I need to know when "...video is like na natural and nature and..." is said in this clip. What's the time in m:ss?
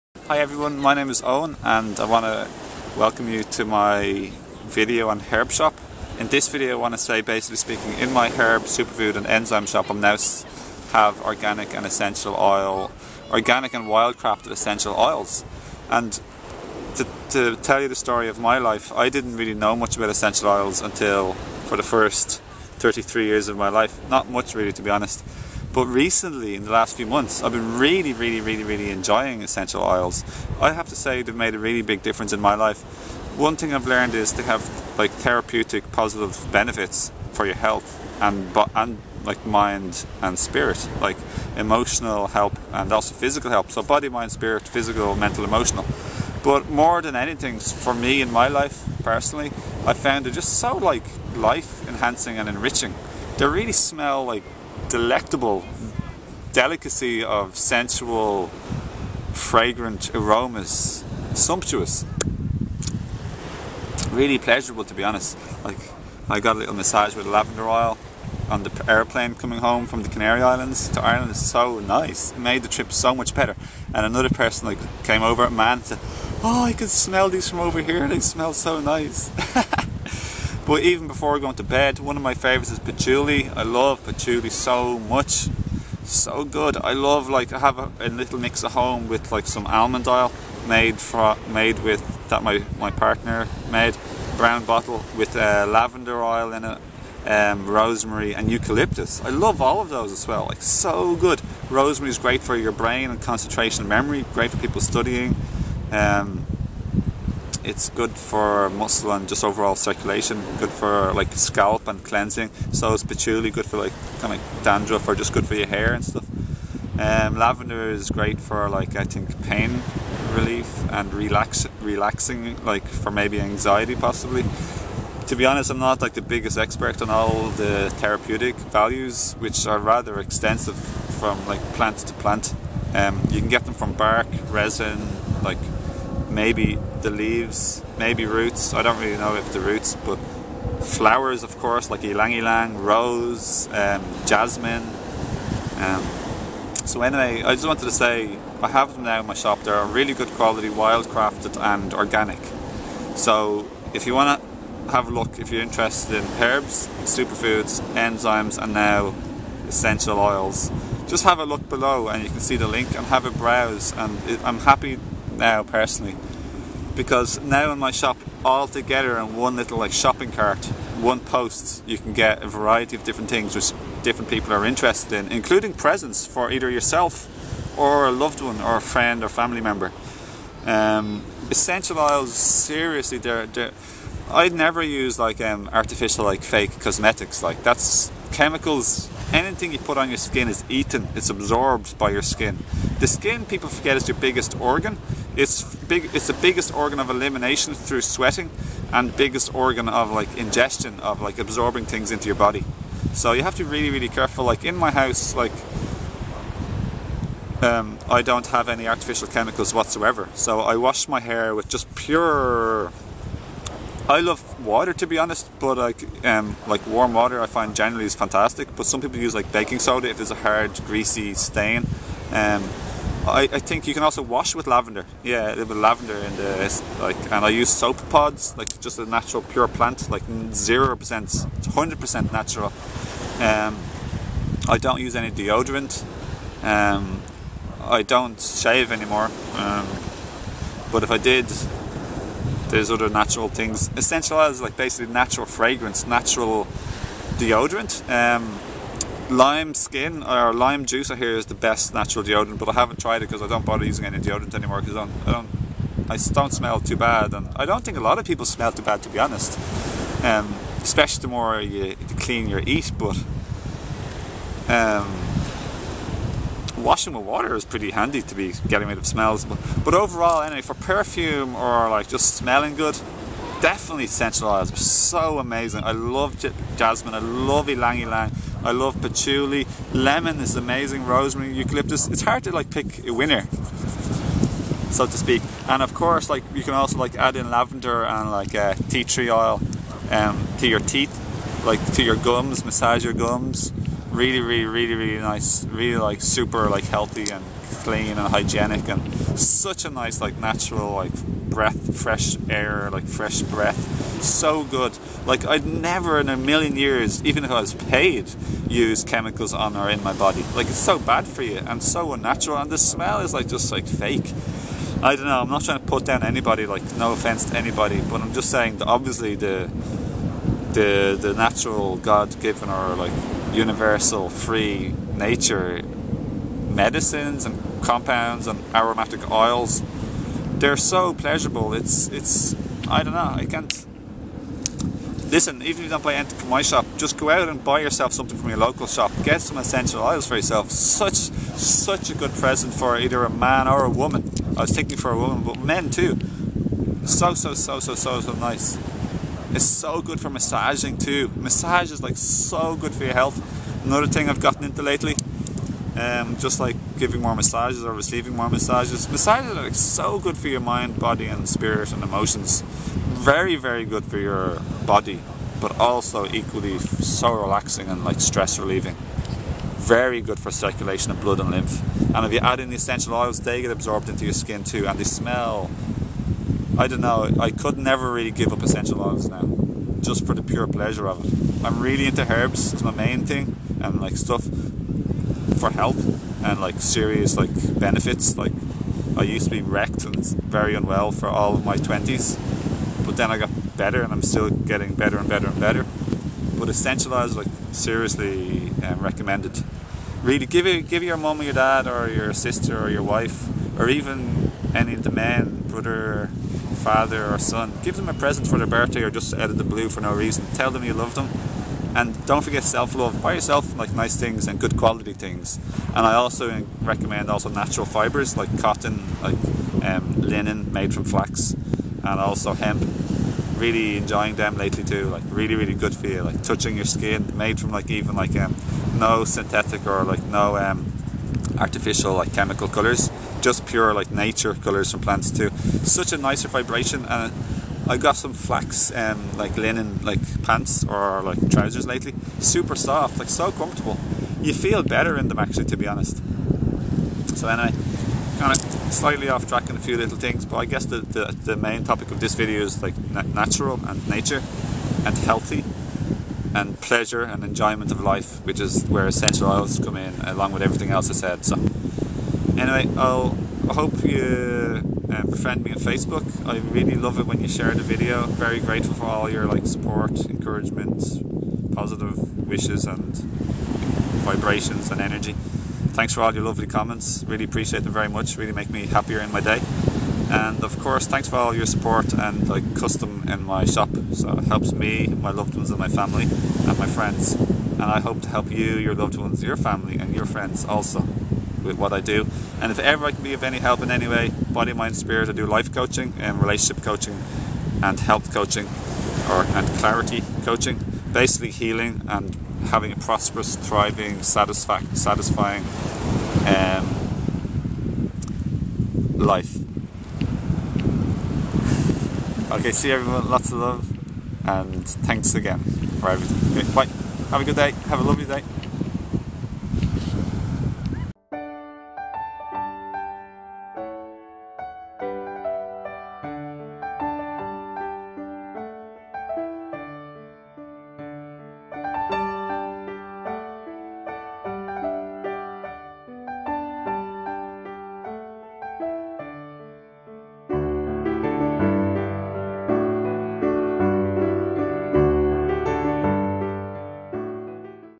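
7:32.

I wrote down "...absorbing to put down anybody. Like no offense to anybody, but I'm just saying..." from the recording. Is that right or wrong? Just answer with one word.
wrong.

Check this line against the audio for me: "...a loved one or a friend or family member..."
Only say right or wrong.
right.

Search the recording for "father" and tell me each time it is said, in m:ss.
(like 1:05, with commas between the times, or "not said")
6:46.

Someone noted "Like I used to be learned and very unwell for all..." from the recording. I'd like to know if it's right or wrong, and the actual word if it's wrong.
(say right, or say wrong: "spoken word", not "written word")
wrong: "wrecked", not "learned".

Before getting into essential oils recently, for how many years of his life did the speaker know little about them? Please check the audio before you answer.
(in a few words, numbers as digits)
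33.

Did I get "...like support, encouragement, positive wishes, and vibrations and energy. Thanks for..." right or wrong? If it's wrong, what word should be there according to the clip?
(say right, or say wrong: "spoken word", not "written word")
right.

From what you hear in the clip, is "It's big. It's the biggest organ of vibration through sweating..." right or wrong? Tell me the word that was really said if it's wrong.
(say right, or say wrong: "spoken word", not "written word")
wrong: "elimination", not "vibration".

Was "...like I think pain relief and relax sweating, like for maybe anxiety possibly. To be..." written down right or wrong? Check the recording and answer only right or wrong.
wrong.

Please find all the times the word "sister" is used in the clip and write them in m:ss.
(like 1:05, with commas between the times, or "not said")
6:42.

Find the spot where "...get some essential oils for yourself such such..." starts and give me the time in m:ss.
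5:39.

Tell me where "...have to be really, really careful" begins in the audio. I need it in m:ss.
3:23.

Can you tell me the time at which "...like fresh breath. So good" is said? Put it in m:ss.
5:02.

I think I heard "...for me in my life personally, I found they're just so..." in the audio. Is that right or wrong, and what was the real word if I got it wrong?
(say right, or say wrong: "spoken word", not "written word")
right.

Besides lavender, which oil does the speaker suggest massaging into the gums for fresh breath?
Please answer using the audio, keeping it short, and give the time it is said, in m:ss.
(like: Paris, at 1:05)
Tea tree oil, at 4:48.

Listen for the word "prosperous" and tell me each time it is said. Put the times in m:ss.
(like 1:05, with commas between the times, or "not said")
8:22.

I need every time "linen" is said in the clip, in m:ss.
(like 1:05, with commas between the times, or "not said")
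7:00, 7:19.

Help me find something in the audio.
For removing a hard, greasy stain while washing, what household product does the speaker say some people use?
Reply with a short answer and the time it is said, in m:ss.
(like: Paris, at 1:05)
Baking soda, at 3:39.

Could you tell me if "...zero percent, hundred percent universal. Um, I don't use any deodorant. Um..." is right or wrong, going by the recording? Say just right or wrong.
wrong.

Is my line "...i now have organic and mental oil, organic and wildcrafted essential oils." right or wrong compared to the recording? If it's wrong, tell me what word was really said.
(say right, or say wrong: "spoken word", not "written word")
wrong: "essential", not "mental".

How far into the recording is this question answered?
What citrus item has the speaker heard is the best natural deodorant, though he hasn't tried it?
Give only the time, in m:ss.
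4:09.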